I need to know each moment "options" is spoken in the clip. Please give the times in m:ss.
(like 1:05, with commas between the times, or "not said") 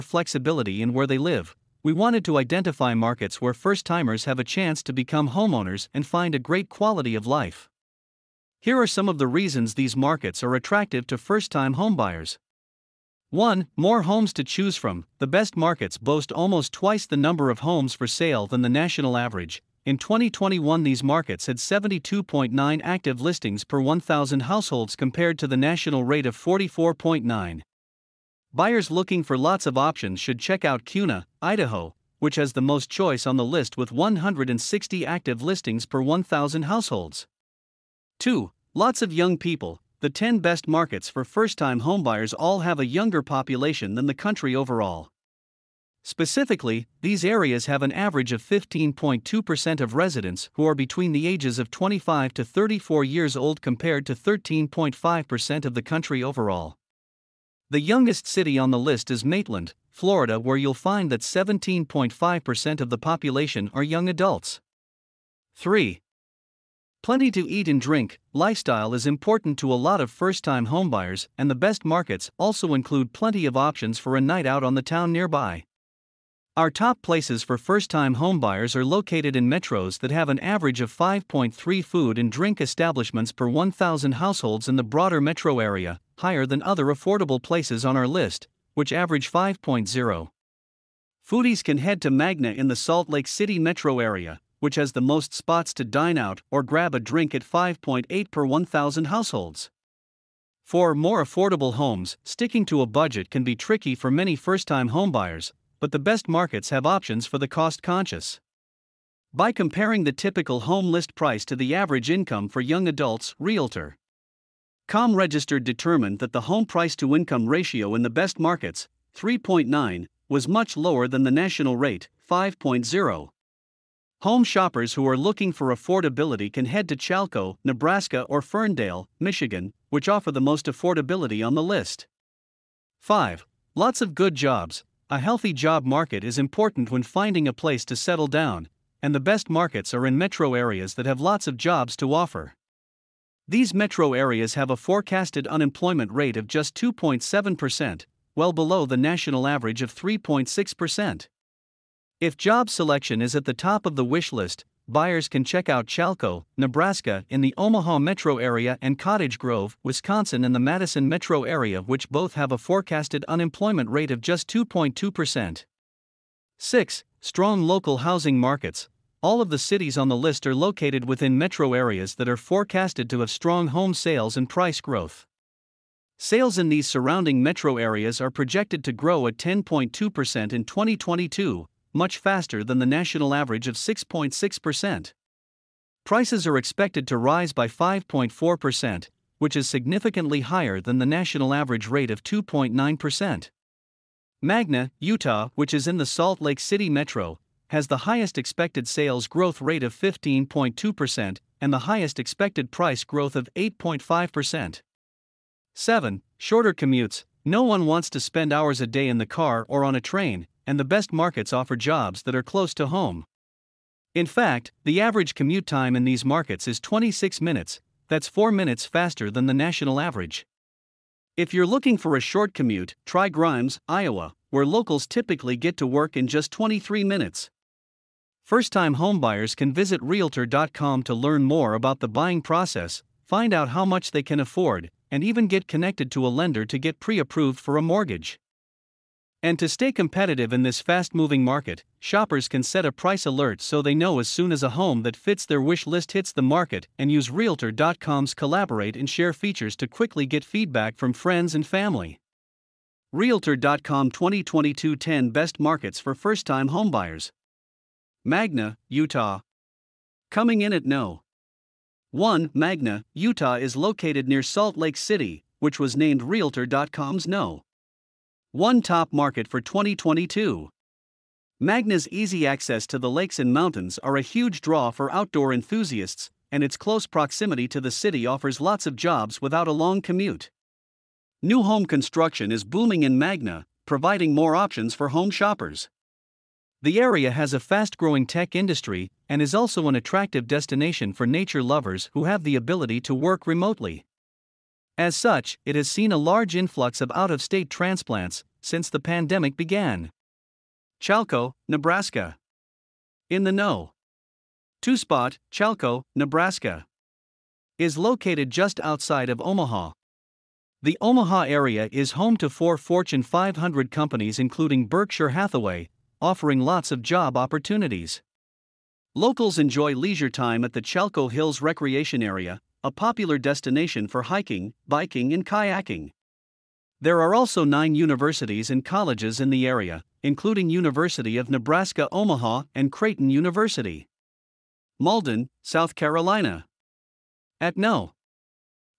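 0:29, 1:13, 1:46, 4:44.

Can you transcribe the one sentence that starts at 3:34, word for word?
In fact, the average commute time in these markets is 26 minutes, that's 4 minutes faster than the national average.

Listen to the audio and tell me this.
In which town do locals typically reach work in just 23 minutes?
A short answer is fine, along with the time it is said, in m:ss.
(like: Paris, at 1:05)
Grimes, Iowa, at 3:43.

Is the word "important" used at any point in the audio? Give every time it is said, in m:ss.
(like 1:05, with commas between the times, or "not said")
1:09, 2:16.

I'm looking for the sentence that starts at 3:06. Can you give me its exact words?
Prices are expected to rise by 5.4%, which is significantly higher than the national average rate of 2.9%.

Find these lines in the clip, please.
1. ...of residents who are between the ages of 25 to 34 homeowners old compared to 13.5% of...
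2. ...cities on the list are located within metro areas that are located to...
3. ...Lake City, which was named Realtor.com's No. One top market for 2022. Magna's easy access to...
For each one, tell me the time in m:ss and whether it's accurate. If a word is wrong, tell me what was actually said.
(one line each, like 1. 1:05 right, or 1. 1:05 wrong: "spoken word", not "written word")
1. 0:49 wrong: "years", not "homeowners"
2. 2:49 wrong: "forecasted", not "located"
3. 4:24 right.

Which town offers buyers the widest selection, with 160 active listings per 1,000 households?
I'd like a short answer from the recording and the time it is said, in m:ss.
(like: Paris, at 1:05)
Kuna, Idaho, at 0:30.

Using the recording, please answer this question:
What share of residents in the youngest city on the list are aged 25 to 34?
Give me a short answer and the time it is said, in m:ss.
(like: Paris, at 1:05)
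17.5%, at 1:01.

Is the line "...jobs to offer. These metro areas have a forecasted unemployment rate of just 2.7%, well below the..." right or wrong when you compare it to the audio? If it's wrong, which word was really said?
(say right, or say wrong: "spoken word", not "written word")
right.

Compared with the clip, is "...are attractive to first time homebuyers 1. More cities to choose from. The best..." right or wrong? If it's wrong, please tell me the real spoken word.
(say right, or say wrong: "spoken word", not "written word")
wrong: "homes", not "cities".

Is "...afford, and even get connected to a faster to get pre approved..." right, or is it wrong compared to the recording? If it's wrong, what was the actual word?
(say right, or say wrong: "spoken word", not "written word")
wrong: "lender", not "faster".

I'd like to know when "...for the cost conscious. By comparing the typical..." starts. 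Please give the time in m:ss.
1:47.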